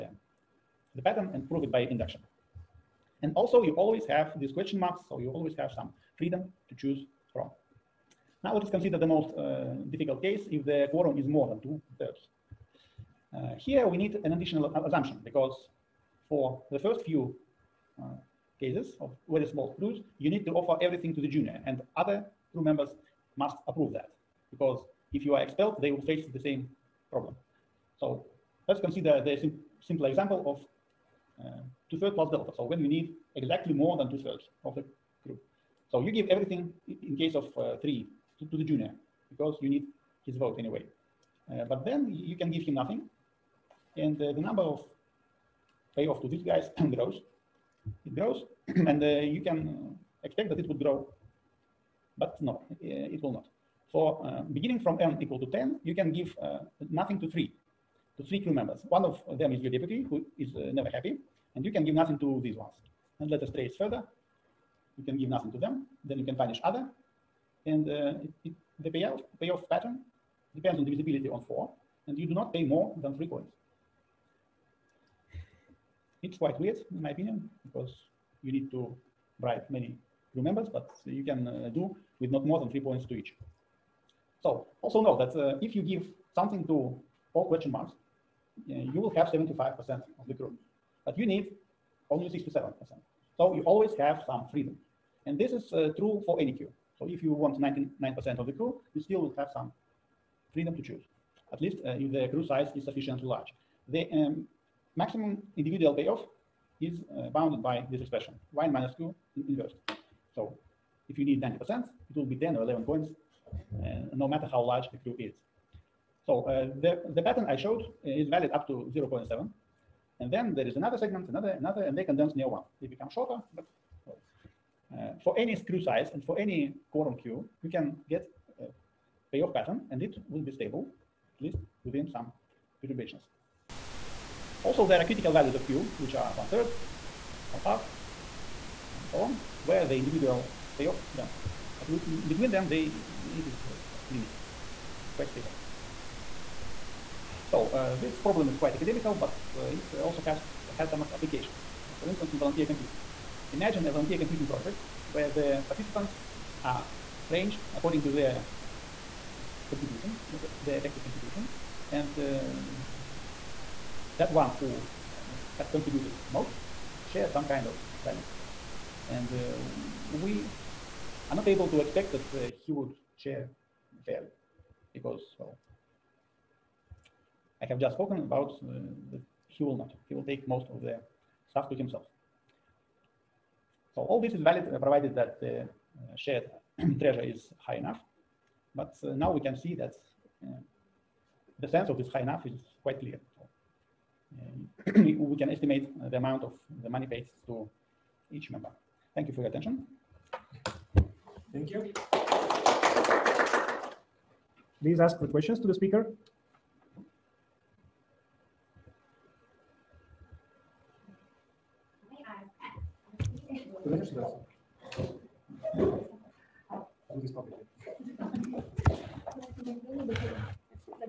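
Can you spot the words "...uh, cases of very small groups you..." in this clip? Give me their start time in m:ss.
0:18.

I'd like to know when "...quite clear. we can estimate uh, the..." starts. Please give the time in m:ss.
3:12.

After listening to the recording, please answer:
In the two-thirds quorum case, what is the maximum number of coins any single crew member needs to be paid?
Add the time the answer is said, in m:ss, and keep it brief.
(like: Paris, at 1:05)
3, at 1:13.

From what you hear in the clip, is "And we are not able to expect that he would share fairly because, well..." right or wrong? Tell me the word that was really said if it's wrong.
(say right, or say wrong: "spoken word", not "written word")
right.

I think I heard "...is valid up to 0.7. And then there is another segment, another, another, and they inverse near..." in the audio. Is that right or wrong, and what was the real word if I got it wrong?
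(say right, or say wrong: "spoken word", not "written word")
wrong: "condense", not "inverse".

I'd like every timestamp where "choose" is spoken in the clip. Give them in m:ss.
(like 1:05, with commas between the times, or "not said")
0:06, 1:40.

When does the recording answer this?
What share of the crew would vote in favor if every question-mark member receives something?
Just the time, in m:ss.
1:29.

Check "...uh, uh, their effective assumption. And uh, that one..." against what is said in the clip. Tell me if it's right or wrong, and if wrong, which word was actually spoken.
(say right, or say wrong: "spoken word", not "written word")
wrong: "contribution", not "assumption".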